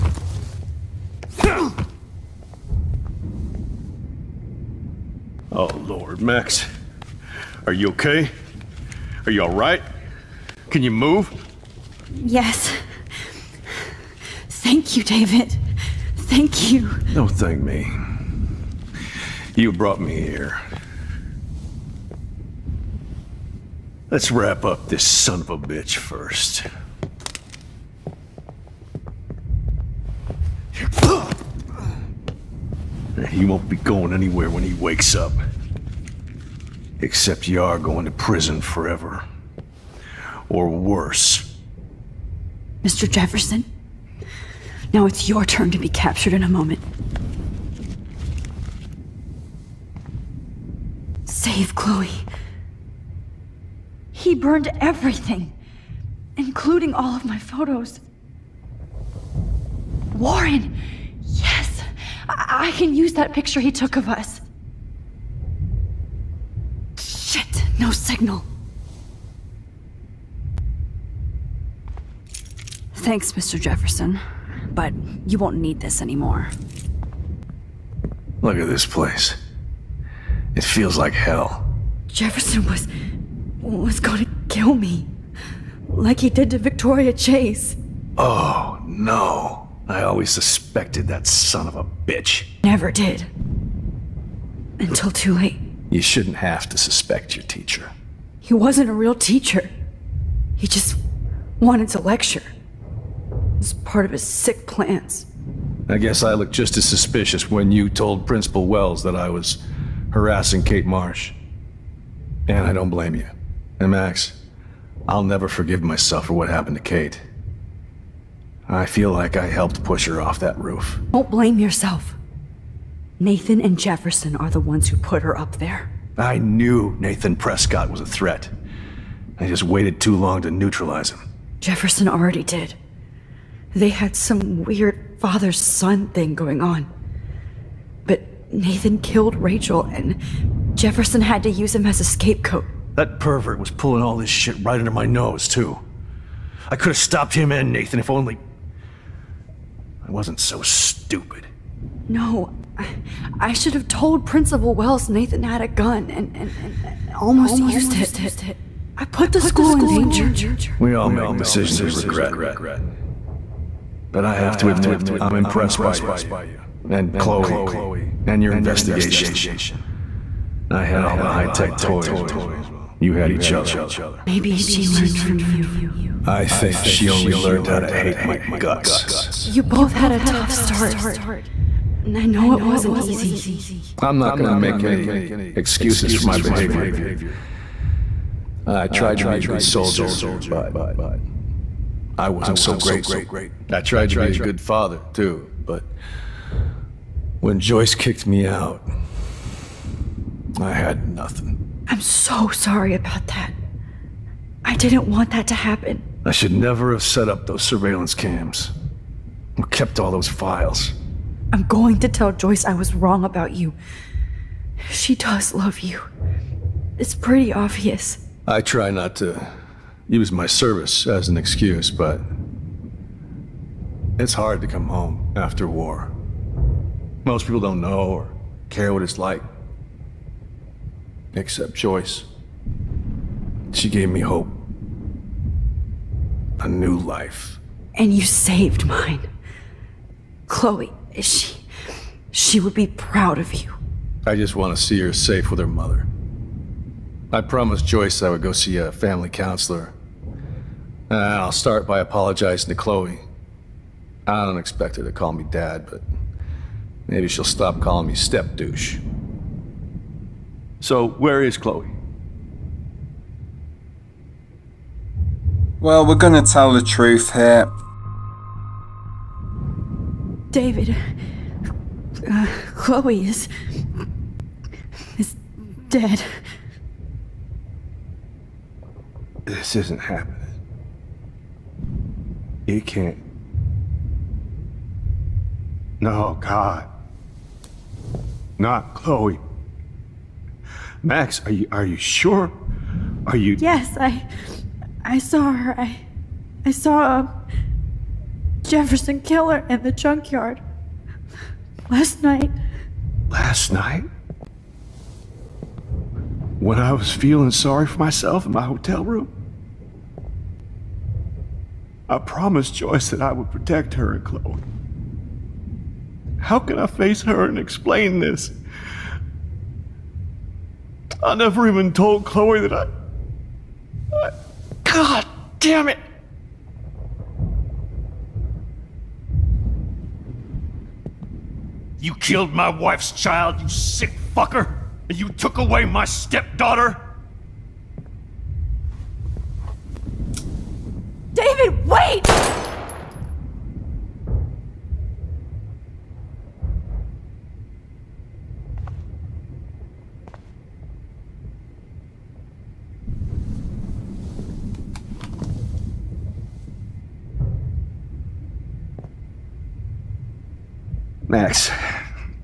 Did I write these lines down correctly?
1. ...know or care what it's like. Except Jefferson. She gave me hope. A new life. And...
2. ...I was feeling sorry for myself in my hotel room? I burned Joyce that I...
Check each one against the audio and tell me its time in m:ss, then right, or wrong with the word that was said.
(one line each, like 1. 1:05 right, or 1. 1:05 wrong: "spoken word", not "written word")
1. 3:47 wrong: "Joyce", not "Jefferson"
2. 5:06 wrong: "promised", not "burned".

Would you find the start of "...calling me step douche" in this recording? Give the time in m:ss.
4:17.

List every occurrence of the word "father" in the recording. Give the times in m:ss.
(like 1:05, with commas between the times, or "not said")
2:15, 3:14.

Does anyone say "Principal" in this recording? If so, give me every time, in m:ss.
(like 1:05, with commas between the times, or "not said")
1:48, 2:34.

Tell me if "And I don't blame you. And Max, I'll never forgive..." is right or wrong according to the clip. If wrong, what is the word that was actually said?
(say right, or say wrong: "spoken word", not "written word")
right.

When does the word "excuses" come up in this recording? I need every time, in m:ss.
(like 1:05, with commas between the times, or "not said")
3:05, 3:41.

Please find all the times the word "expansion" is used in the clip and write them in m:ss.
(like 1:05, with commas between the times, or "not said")
not said.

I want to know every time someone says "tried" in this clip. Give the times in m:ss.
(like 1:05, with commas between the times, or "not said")
3:08, 3:13.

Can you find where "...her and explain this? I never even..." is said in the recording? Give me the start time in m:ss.
5:17.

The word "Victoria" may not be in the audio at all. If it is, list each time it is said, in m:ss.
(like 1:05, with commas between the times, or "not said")
1:26.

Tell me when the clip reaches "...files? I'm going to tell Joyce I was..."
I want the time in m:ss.
3:30.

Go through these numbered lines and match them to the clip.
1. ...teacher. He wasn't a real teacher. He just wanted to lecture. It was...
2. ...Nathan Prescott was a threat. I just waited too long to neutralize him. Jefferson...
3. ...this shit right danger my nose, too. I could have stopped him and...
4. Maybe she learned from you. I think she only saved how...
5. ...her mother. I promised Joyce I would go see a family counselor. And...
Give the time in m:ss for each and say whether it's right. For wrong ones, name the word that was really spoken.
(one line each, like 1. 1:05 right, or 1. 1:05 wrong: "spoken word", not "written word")
1. 1:37 right
2. 2:06 right
3. 2:24 wrong: "under", not "danger"
4. 2:54 wrong: "learned", not "saved"
5. 4:05 right.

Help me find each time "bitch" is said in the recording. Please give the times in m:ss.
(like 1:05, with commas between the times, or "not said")
0:25, 1:31.